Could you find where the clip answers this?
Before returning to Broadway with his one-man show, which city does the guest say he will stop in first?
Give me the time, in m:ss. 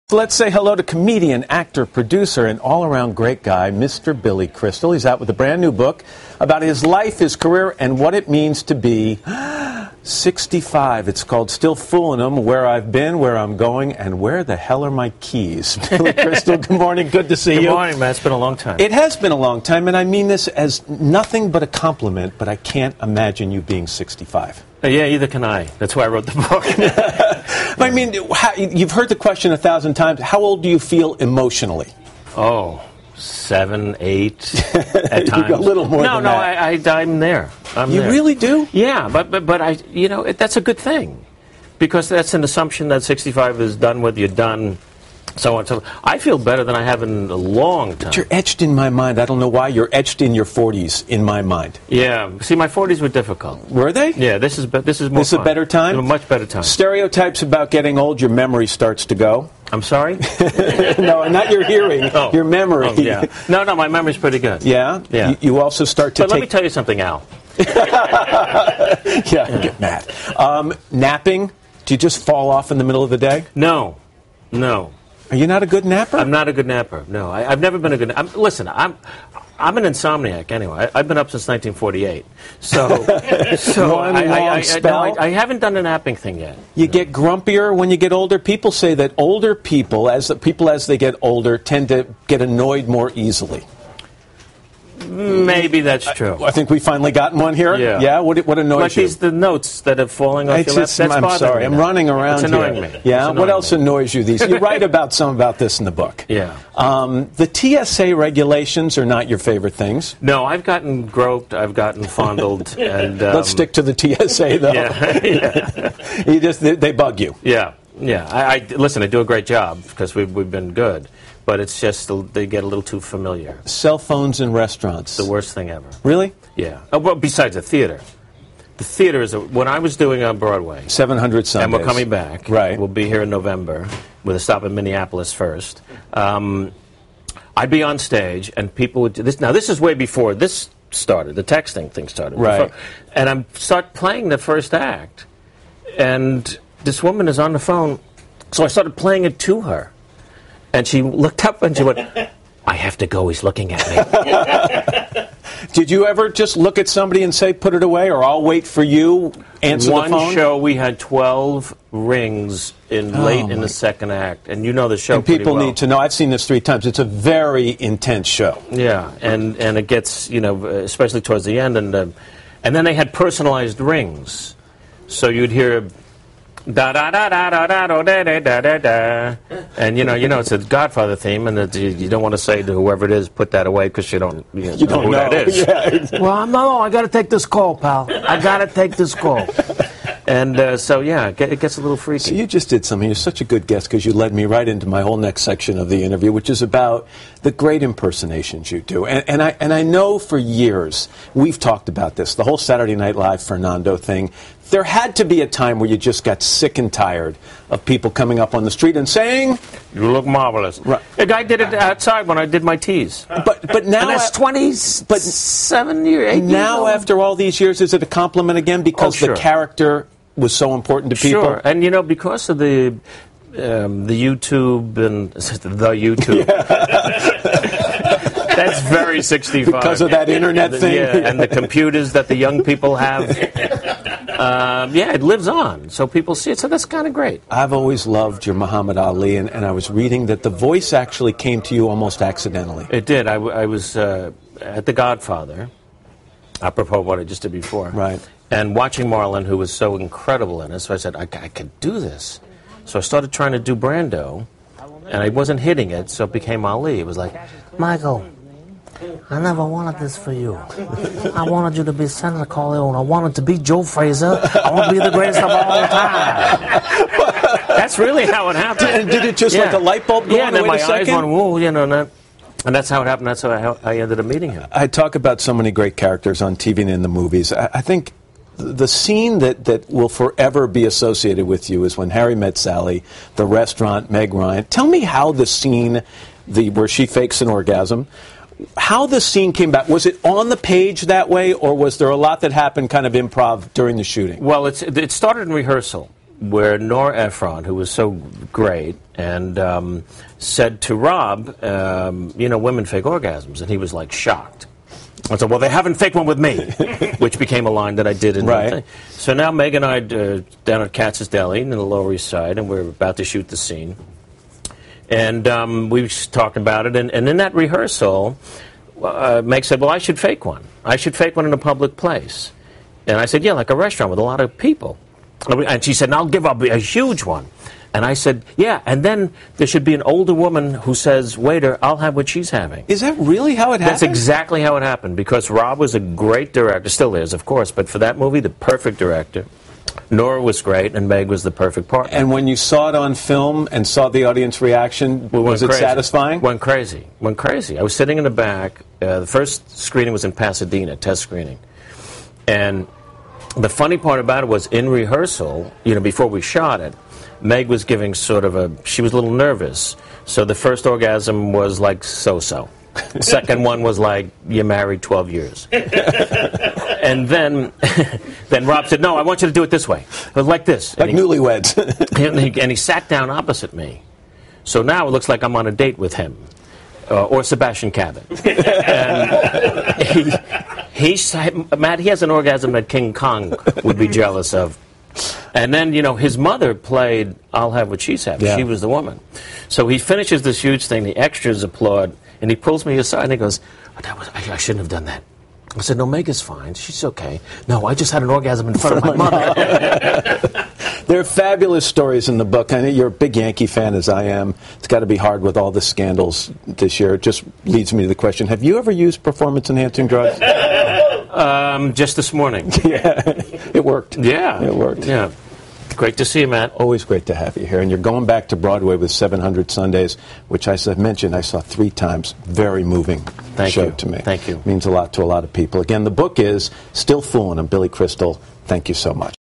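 2:14.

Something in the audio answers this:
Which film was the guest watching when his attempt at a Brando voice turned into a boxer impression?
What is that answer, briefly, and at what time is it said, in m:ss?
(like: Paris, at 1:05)
The Godfather, at 4:04.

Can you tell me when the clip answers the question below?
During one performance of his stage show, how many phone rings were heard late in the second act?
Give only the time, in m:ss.
2:40.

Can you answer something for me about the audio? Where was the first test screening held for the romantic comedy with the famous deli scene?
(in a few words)
Pasadena.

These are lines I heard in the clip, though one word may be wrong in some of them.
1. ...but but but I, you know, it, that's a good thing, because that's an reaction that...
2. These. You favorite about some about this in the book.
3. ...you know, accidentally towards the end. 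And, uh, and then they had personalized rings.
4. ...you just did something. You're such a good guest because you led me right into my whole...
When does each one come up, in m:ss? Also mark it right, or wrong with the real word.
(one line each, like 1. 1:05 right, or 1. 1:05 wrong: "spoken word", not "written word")
1. 0:39 wrong: "assumption", not "reaction"
2. 1:44 wrong: "write", not "favorite"
3. 2:50 wrong: "especially", not "accidentally"
4. 3:12 right.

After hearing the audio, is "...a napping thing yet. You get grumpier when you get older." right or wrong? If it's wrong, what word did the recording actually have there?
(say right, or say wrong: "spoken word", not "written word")
right.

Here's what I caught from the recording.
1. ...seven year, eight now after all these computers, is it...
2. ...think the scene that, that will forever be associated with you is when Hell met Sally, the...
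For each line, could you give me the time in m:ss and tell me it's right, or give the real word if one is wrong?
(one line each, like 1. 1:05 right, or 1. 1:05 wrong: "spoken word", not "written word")
1. 3:35 wrong: "years", not "computers"
2. 4:37 wrong: "Harry", not "Hell".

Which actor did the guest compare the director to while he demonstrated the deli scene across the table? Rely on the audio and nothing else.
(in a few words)
Sebastian Cabot.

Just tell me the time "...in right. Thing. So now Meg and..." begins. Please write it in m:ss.
5:08.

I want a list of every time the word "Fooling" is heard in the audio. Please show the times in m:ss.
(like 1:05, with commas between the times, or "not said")
0:11, 7:07.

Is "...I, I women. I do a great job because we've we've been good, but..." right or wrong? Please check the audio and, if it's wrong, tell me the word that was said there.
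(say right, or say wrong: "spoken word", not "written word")
wrong: "listen", not "women".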